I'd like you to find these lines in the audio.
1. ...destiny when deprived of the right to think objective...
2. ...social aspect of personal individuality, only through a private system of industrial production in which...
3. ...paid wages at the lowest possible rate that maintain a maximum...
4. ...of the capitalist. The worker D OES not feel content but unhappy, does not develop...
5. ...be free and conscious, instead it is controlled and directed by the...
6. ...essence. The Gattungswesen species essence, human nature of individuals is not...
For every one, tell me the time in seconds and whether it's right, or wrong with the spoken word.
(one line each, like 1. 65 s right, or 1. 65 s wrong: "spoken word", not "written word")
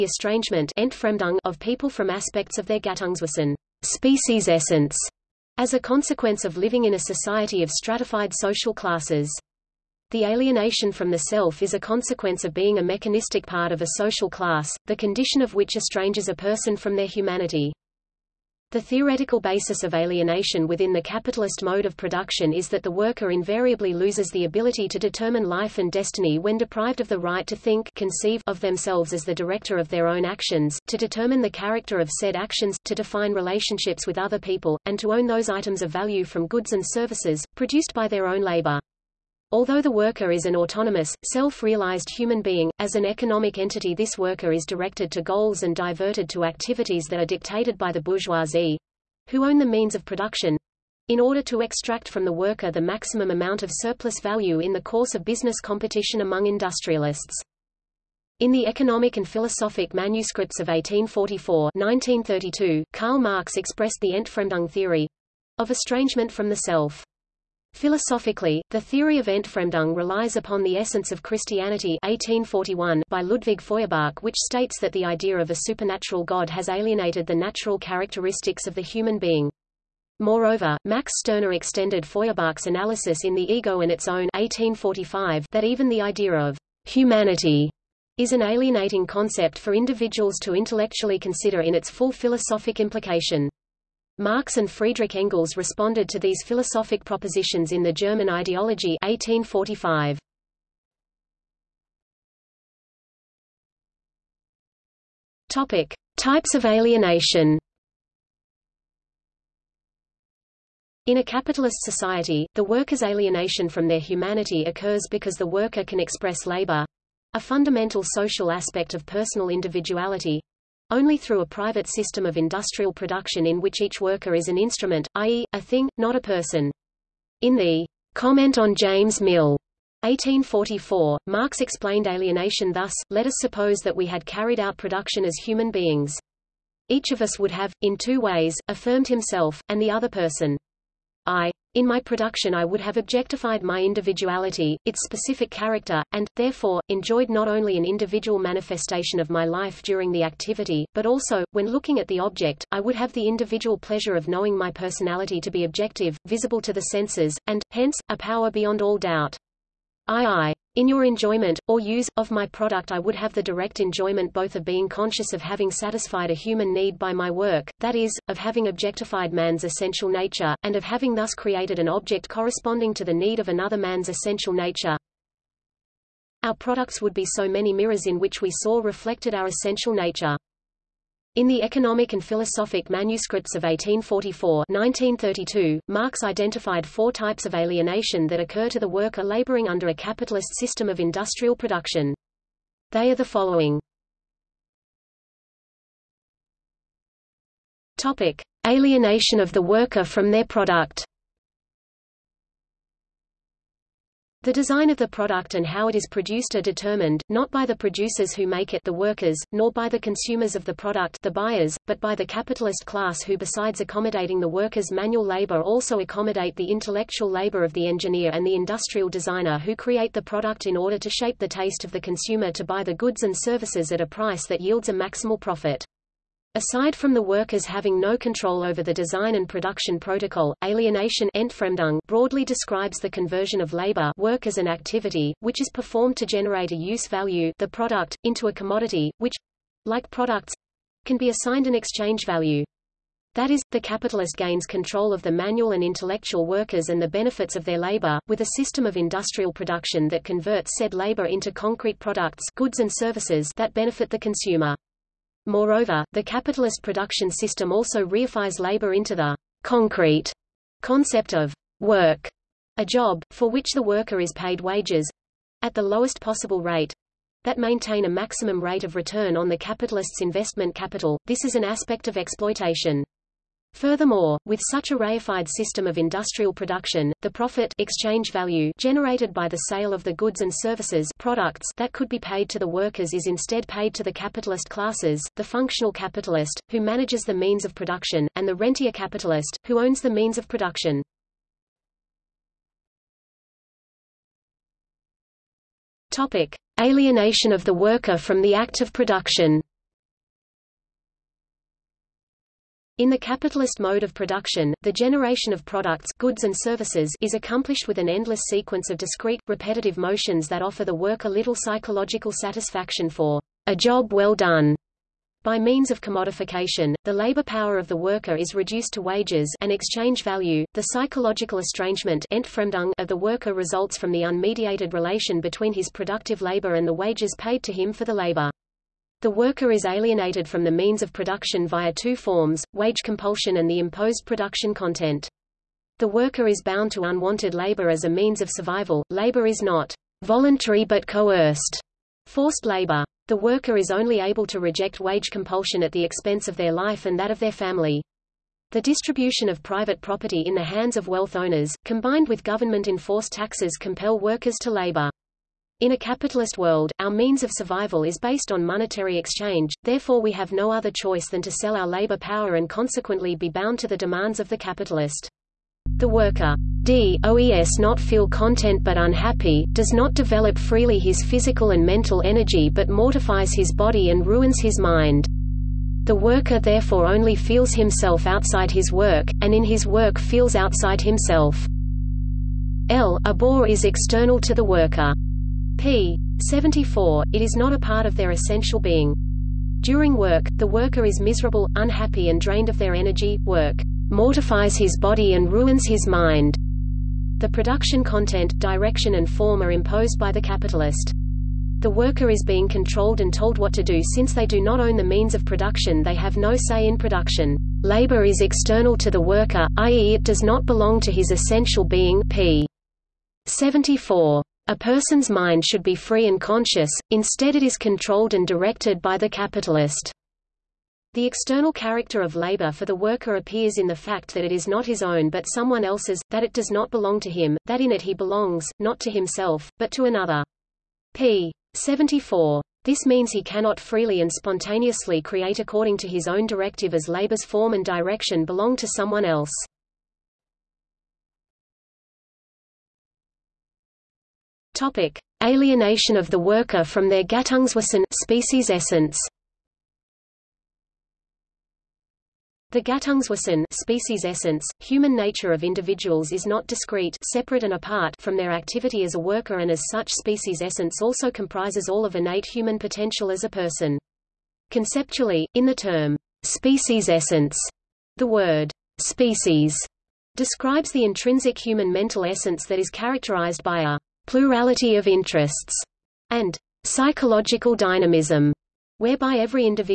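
1. 25 s wrong: "conceive", not "objective"
2. 118 s right
3. 264 s right
4. 364 s right
5. 415 s right
6. 448 s right.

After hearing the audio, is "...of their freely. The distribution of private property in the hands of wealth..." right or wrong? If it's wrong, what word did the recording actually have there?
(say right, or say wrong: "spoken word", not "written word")
wrong: "family", not "freely".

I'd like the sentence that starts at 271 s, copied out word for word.
This is an aspect of exploitation.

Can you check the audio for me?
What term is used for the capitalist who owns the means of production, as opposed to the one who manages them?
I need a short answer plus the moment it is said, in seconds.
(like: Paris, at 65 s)
rentier capitalist, at 288 s.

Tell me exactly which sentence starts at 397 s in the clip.
The production content, direction and form are imposed by the capitalist.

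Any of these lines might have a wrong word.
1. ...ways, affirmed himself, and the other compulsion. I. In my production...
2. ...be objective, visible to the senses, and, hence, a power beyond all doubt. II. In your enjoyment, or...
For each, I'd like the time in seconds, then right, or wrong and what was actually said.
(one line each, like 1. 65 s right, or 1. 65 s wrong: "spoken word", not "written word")
1. 138 s wrong: "person", not "compulsion"
2. 155 s right.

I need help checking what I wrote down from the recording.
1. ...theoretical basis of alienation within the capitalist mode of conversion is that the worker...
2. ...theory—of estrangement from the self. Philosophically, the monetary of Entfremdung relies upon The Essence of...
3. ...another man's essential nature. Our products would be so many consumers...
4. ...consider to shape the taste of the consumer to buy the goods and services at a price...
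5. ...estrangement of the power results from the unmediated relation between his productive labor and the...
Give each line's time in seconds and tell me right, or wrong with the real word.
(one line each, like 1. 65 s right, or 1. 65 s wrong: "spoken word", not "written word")
1. 18 s wrong: "production", not "conversion"
2. 64 s wrong: "theory", not "monetary"
3. 173 s wrong: "mirrors", not "consumers"
4. 220 s wrong: "order", not "consider"
5. 321 s wrong: "worker", not "power".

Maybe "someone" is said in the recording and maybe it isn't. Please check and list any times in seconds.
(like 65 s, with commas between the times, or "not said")
425 s, 438 s.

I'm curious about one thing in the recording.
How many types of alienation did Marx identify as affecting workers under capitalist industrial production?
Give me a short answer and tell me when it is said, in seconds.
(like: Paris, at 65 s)
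4, at 186 s.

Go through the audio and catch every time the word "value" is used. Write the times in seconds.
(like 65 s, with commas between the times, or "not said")
35 s, 54 s, 237 s, 242 s, 278 s, 320 s.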